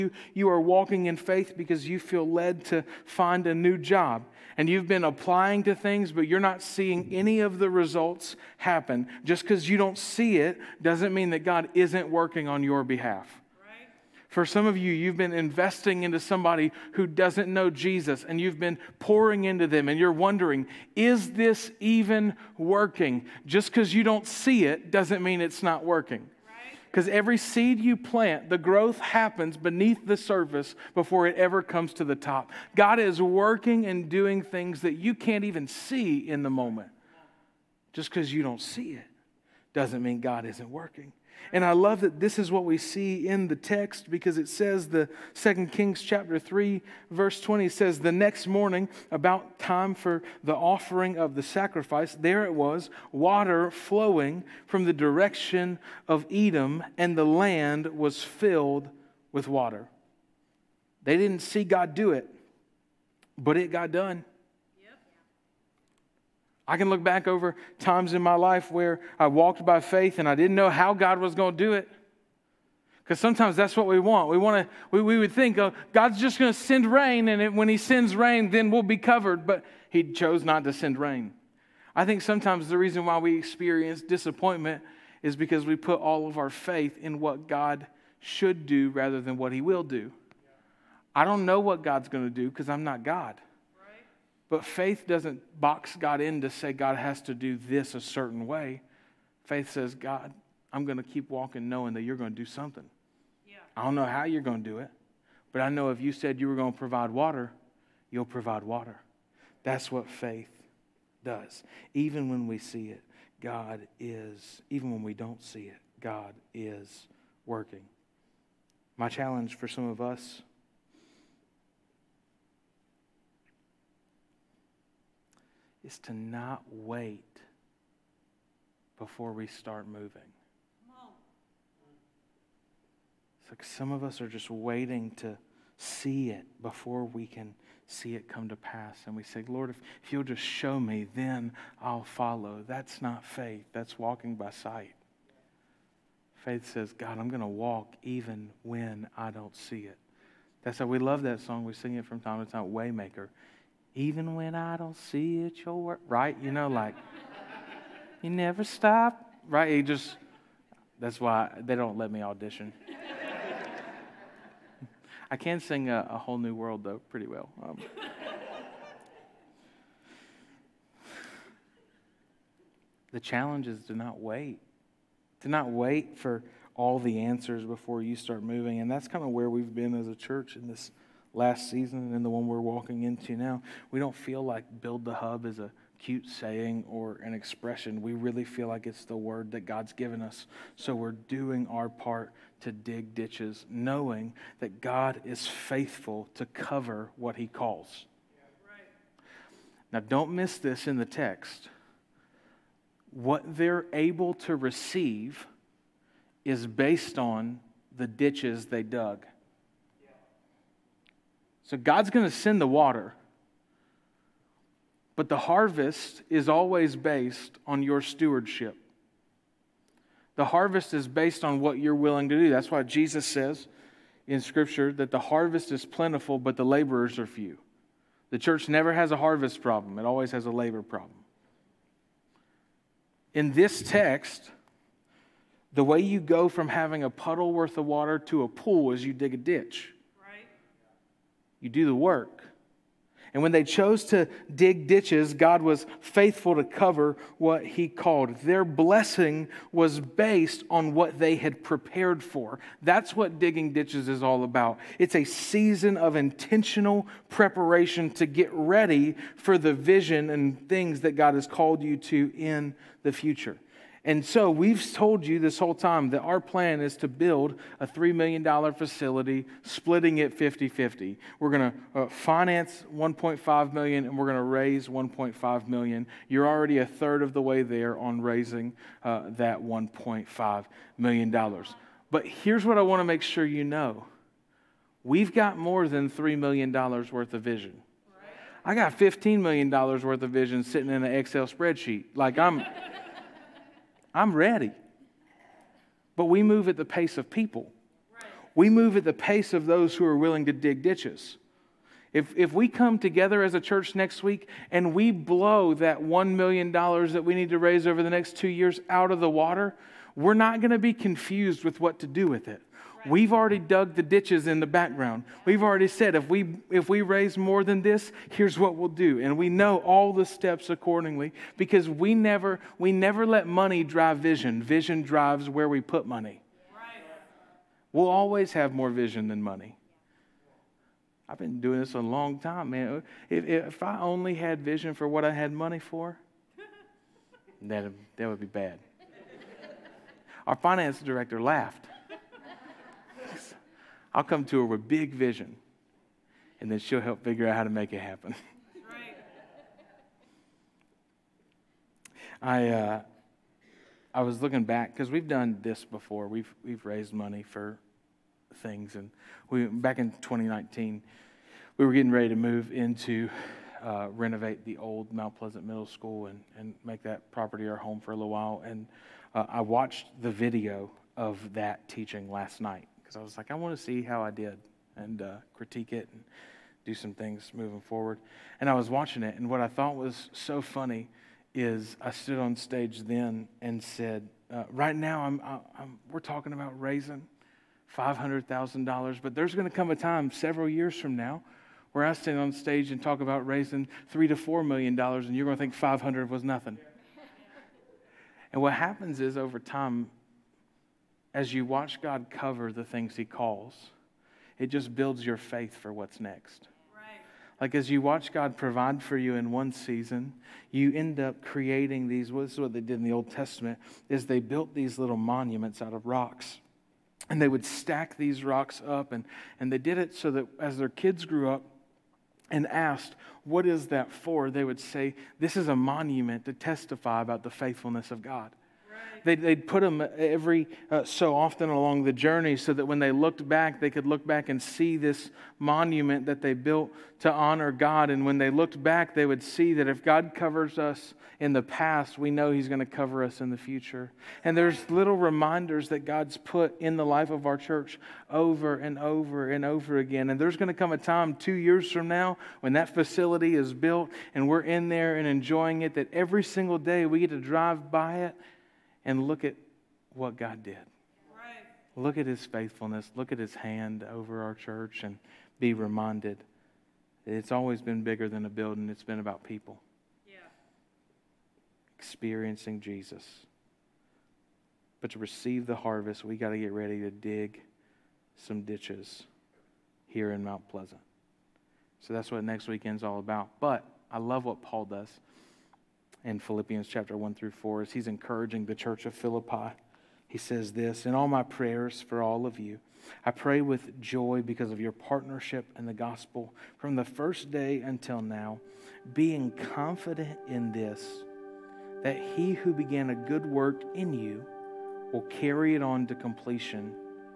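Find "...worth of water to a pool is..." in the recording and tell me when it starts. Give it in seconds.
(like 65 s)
237 s.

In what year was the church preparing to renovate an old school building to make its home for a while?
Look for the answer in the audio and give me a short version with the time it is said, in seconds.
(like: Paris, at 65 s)
2019, at 360 s.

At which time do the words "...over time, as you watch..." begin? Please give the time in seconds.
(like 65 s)
399 s.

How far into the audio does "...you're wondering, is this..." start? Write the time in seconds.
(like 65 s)
19 s.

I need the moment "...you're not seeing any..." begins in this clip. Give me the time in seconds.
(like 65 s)
6 s.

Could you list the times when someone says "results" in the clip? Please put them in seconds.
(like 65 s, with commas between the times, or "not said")
7 s.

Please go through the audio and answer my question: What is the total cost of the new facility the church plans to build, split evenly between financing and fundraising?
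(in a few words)
$3 million.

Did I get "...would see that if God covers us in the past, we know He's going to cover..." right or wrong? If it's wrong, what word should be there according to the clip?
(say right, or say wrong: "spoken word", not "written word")
right.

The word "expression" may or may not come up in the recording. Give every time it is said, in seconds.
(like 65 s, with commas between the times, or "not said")
187 s.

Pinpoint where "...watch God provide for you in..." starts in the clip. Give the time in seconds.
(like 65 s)
408 s.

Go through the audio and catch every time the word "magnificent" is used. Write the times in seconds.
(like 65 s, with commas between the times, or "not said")
not said.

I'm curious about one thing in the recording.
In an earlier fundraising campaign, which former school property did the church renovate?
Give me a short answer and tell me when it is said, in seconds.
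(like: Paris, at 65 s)
Mount Pleasant Middle School, at 365 s.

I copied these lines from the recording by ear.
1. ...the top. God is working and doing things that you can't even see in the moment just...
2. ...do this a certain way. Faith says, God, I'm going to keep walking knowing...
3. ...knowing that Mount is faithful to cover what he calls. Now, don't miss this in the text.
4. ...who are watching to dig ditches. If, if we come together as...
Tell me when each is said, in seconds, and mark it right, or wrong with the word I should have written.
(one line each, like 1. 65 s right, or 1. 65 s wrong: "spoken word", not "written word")
1. 32 s right
2. 97 s right
3. 193 s wrong: "God", not "Mount"
4. 299 s wrong: "willing", not "watching".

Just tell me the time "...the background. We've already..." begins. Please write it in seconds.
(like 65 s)
314 s.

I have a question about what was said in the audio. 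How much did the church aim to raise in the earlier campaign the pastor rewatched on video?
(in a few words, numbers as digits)
$500,000.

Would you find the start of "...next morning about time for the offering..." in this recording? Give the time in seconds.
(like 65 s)
48 s.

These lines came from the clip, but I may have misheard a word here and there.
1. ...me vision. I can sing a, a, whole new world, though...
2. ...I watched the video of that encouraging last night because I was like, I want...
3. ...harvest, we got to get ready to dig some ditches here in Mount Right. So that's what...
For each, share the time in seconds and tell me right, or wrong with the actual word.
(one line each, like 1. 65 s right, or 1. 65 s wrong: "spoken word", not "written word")
1. 162 s wrong: "audition", not "vision"
2. 369 s wrong: "teaching", not "encouraging"
3. 475 s wrong: "Pleasant", not "Right".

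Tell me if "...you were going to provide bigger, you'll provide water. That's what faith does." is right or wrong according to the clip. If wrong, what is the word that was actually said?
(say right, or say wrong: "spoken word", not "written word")
wrong: "water", not "bigger".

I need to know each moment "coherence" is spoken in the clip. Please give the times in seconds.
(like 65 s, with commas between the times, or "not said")
not said.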